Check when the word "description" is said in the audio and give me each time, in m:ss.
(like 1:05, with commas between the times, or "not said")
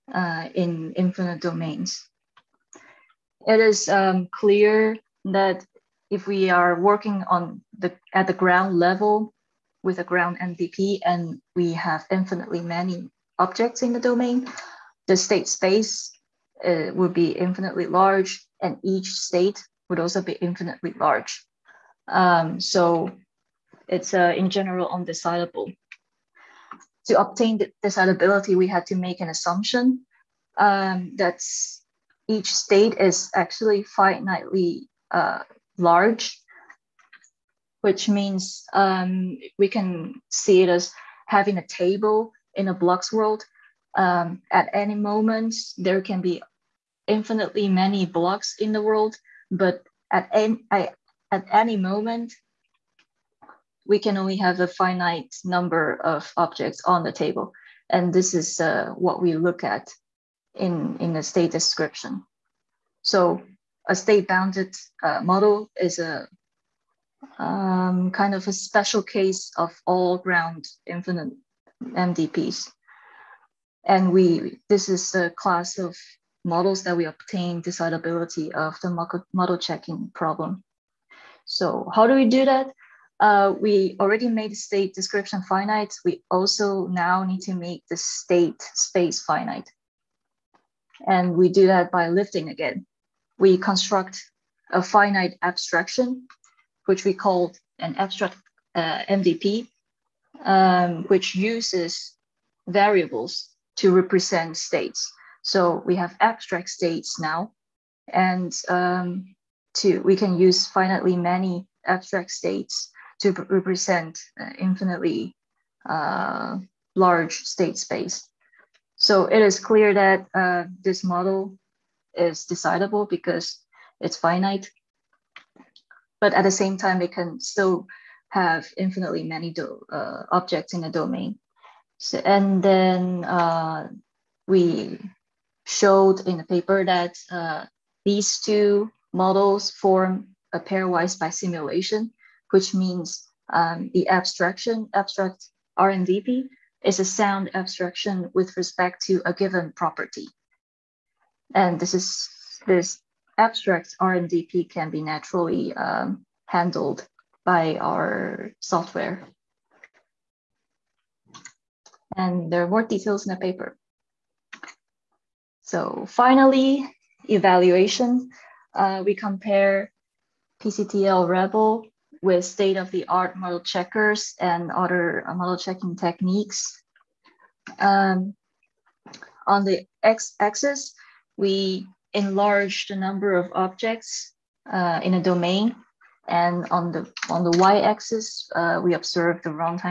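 1:01, 1:24.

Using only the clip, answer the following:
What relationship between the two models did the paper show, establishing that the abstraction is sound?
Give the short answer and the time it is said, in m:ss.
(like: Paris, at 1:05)
pairwise bisimulation, at 2:20.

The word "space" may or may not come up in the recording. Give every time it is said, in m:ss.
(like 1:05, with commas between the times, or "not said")
0:15, 1:28, 1:57.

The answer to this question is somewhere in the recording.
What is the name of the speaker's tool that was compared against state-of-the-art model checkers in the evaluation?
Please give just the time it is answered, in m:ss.
2:50.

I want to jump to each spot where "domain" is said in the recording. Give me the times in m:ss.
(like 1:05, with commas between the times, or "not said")
0:01, 0:13, 2:10, 3:05.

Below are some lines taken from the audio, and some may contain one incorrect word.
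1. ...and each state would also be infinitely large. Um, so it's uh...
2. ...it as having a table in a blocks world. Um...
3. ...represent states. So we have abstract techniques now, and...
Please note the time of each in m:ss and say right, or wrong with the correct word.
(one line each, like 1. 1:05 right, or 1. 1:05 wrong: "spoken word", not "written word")
1. 0:18 right
2. 0:40 right
3. 1:43 wrong: "states", not "techniques".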